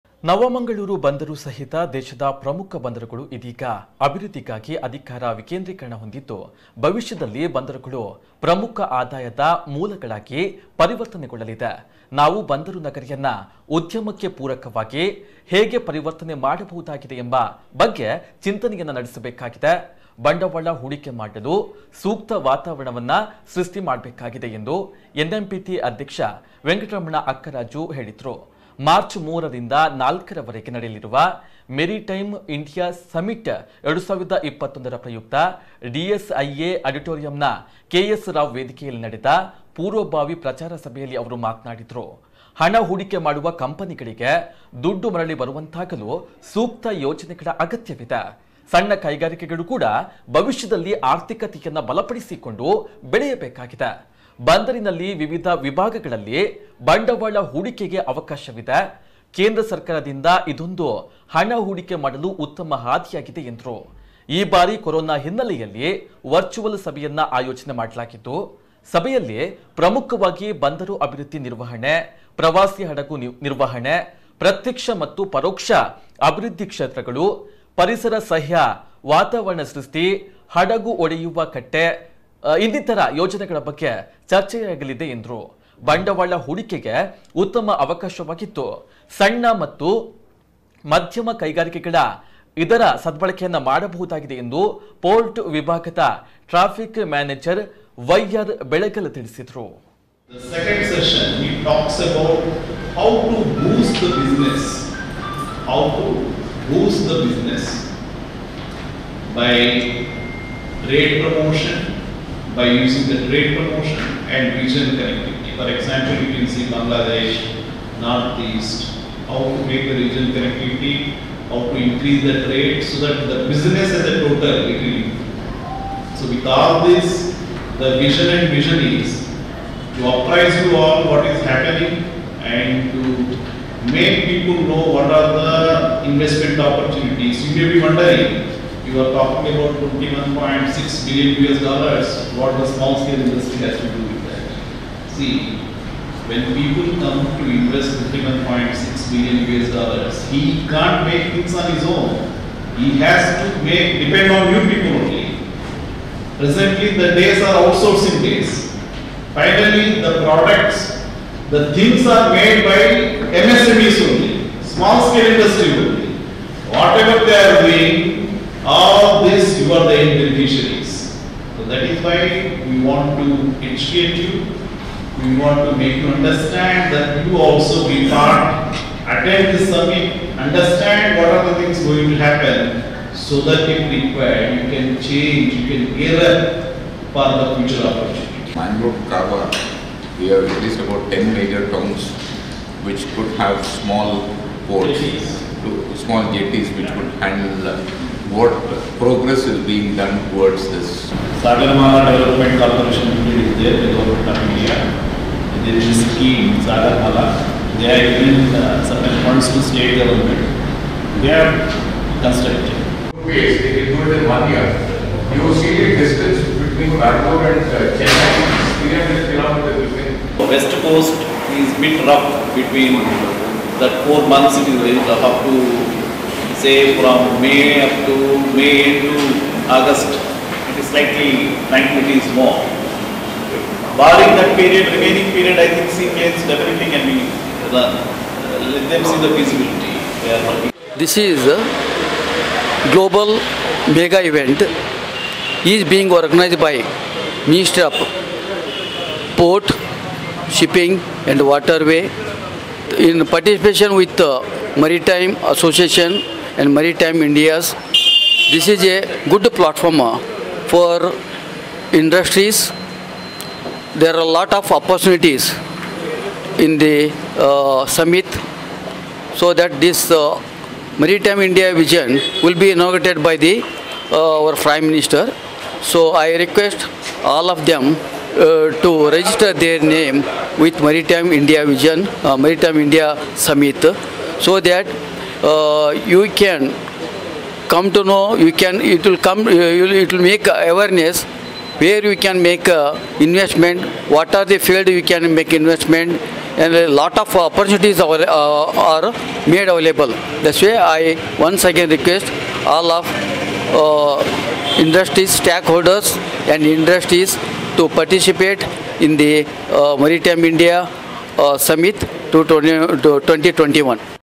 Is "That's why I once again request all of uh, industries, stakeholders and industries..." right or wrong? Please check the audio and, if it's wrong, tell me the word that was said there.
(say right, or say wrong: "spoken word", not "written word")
right.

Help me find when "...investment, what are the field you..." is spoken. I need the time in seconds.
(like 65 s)
293 s.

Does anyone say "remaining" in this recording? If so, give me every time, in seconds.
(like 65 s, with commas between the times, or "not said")
234 s.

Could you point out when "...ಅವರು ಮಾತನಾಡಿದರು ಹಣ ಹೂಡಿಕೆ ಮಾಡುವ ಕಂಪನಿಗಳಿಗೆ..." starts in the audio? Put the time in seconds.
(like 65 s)
41 s.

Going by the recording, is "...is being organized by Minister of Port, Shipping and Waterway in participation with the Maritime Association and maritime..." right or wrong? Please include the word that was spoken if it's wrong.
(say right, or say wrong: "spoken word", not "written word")
right.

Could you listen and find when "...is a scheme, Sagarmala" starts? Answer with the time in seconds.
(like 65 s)
205 s.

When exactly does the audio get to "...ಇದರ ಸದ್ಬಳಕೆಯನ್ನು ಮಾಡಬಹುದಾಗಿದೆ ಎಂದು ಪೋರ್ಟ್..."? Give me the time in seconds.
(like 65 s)
92 s.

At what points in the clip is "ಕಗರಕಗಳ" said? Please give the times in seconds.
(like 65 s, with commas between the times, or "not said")
49 s, 91 s.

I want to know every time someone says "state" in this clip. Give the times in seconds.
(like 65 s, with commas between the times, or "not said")
209 s.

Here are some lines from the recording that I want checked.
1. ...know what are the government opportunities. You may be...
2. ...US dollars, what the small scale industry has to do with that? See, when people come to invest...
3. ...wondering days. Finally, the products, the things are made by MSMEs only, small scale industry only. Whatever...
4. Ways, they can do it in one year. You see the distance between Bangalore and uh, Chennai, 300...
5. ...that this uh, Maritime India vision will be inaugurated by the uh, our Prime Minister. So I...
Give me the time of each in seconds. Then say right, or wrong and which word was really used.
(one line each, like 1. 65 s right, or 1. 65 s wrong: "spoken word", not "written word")
1. 134 s wrong: "investment", not "government"
2. 141 s right
3. 157 s wrong: "outsourcing", not "wondering"
4. 213 s right
5. 269 s right.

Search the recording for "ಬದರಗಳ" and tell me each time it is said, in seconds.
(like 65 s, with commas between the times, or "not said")
2 s, 7 s.